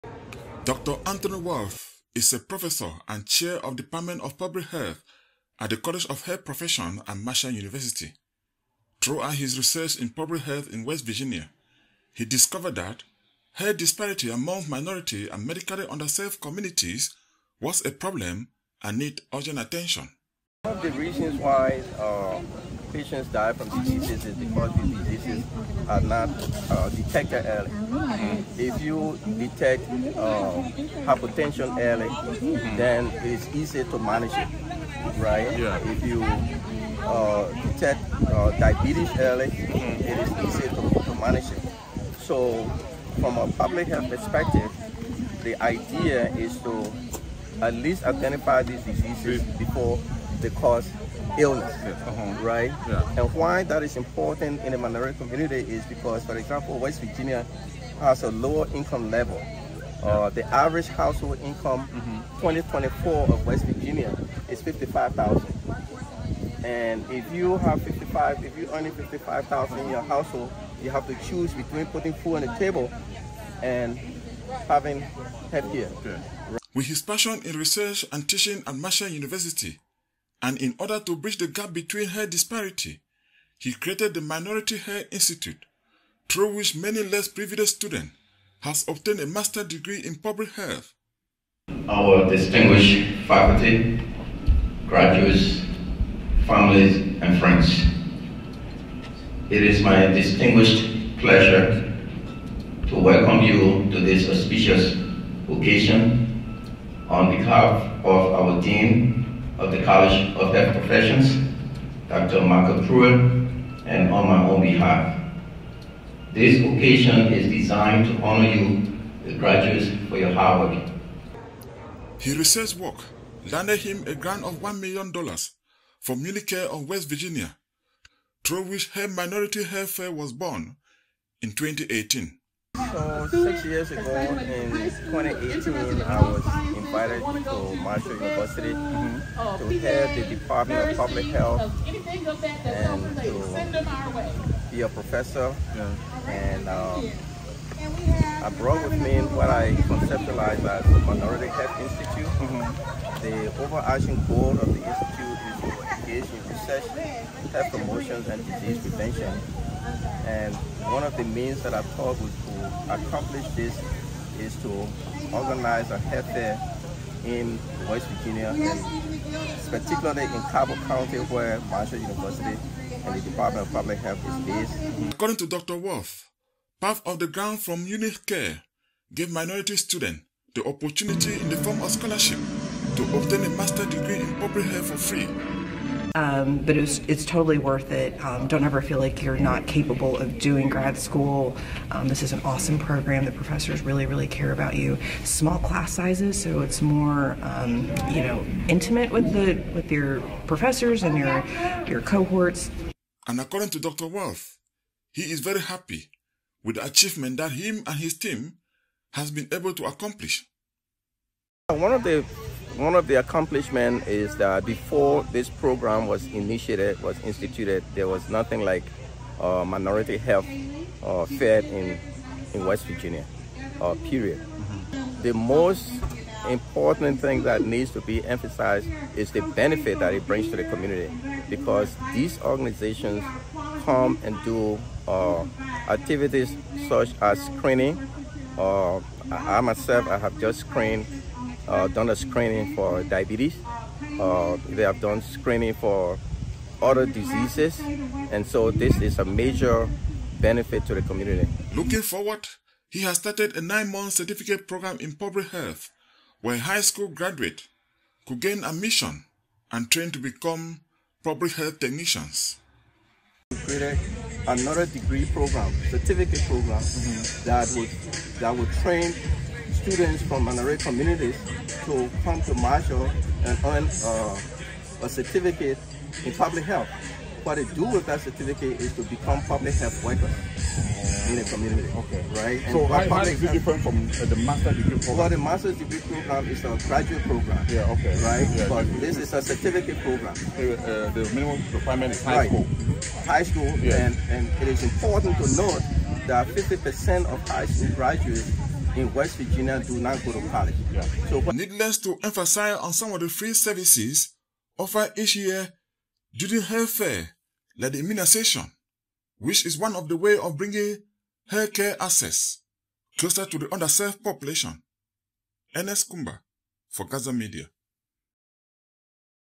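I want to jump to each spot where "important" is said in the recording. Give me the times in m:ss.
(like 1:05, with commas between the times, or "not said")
0:53, 3:46, 4:54.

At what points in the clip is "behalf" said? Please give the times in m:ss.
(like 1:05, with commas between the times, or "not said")
1:47, 1:54.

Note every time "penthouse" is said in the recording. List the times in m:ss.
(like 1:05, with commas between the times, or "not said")
not said.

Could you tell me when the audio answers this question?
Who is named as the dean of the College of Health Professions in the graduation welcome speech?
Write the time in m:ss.
1:52.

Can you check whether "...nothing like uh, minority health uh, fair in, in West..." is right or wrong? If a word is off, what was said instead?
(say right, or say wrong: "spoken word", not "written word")
right.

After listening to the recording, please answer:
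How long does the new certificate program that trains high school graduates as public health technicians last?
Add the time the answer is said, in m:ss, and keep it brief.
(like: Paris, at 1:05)
9 months, at 4:13.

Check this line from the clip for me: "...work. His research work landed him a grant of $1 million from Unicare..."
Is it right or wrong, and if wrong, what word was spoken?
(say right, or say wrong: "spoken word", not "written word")
right.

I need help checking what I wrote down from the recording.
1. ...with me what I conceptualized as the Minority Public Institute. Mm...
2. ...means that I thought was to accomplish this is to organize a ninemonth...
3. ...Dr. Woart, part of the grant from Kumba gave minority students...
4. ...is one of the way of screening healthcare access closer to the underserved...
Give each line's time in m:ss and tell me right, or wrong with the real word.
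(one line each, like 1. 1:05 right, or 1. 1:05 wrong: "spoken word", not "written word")
1. 2:28 wrong: "Health", not "Public"
2. 2:41 wrong: "health", not "ninemonth"
3. 2:55 wrong: "Unicare", not "Kumba"
4. 5:09 wrong: "bringing", not "screening".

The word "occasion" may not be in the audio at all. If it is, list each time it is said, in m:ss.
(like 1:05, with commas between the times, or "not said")
1:45, 1:56.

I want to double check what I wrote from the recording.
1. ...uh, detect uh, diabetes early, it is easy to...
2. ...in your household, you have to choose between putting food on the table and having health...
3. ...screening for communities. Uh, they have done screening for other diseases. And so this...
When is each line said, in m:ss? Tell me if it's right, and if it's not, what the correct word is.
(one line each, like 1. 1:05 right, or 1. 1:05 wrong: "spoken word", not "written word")
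1. 0:37 right
2. 1:09 right
3. 4:02 wrong: "diabetes", not "communities".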